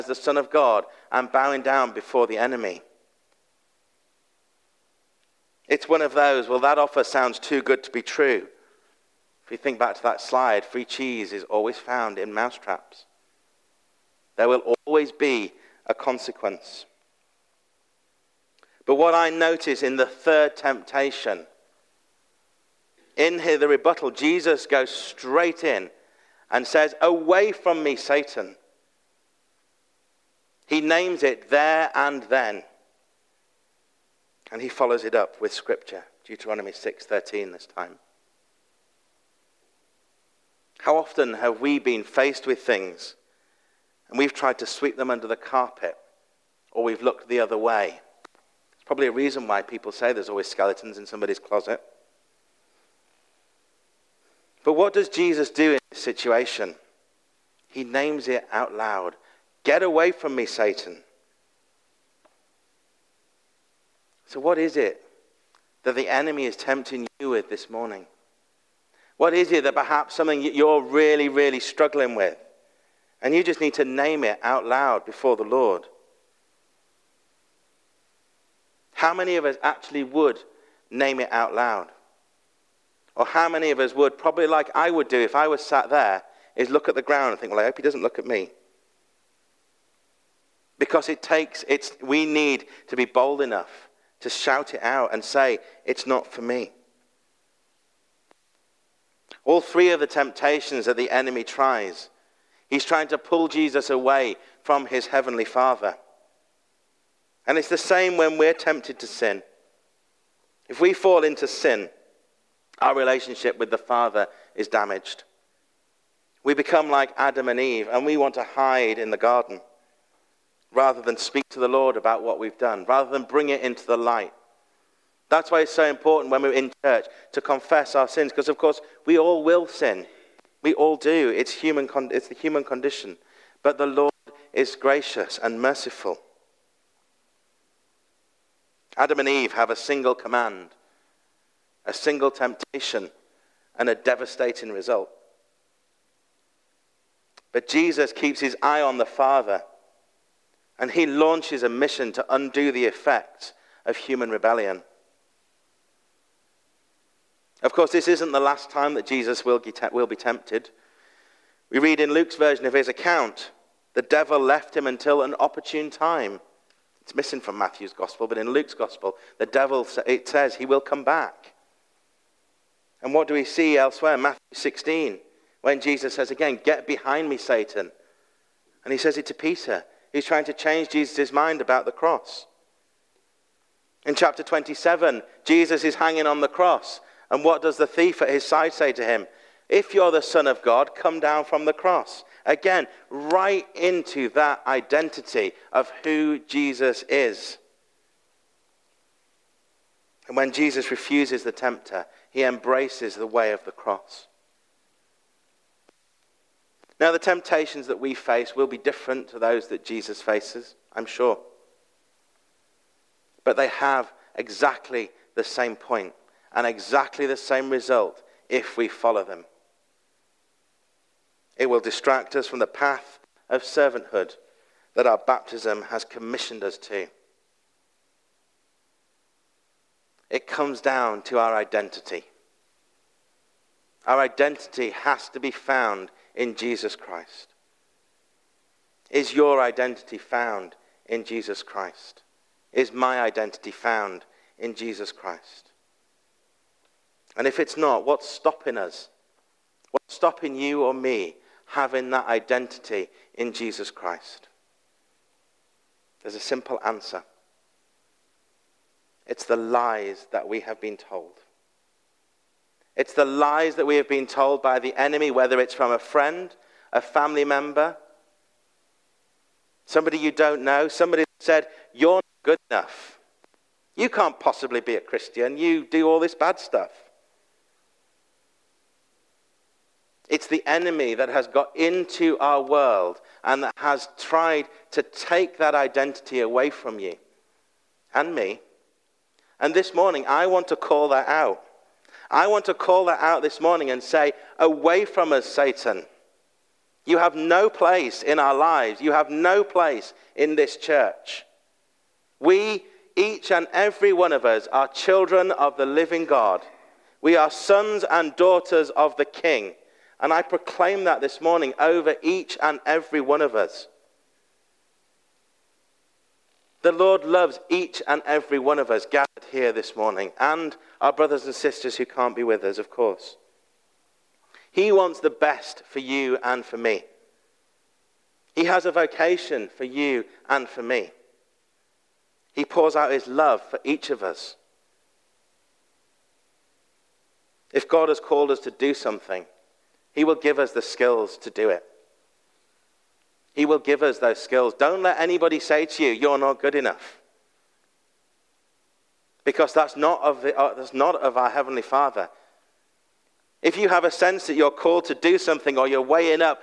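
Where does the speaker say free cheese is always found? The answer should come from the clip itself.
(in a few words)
Mousetraps.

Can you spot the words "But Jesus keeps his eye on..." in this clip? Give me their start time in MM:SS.
02:27.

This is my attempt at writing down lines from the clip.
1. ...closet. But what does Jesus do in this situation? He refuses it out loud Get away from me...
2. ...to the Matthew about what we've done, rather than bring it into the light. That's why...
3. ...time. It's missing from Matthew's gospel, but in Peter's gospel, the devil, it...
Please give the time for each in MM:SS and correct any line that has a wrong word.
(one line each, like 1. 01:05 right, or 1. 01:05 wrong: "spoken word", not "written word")
1. 00:51 wrong: "names", not "refuses"
2. 02:01 wrong: "Lord", not "Matthew"
3. 02:45 wrong: "Luke", not "Peter".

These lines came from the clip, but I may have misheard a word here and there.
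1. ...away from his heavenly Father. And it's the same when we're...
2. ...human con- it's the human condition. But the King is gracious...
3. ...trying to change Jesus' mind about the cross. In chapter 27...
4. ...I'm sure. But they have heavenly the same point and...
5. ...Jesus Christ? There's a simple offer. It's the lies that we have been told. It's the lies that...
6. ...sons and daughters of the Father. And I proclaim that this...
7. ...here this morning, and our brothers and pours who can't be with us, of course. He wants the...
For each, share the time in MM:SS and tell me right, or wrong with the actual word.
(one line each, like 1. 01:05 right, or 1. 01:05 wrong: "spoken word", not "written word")
1. 01:43 right
2. 02:11 wrong: "Lord", not "King"
3. 03:00 right
4. 03:30 wrong: "exactly", not "heavenly"
5. 04:13 wrong: "answer", not "offer"
6. 05:07 wrong: "King", not "Father"
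7. 05:19 wrong: "sisters", not "pours".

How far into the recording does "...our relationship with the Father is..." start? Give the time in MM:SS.
01:52.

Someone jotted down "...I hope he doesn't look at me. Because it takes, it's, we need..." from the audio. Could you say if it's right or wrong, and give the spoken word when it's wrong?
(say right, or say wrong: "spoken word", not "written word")
right.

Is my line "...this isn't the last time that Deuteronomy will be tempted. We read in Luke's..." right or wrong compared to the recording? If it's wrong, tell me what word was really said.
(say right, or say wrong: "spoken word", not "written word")
wrong: "Jesus", not "Deuteronomy".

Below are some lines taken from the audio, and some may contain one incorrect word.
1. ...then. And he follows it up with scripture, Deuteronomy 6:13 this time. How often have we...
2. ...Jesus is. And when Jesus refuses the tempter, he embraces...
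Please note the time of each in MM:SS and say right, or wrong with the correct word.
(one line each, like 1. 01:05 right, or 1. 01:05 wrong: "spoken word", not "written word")
1. 00:32 right
2. 03:16 right.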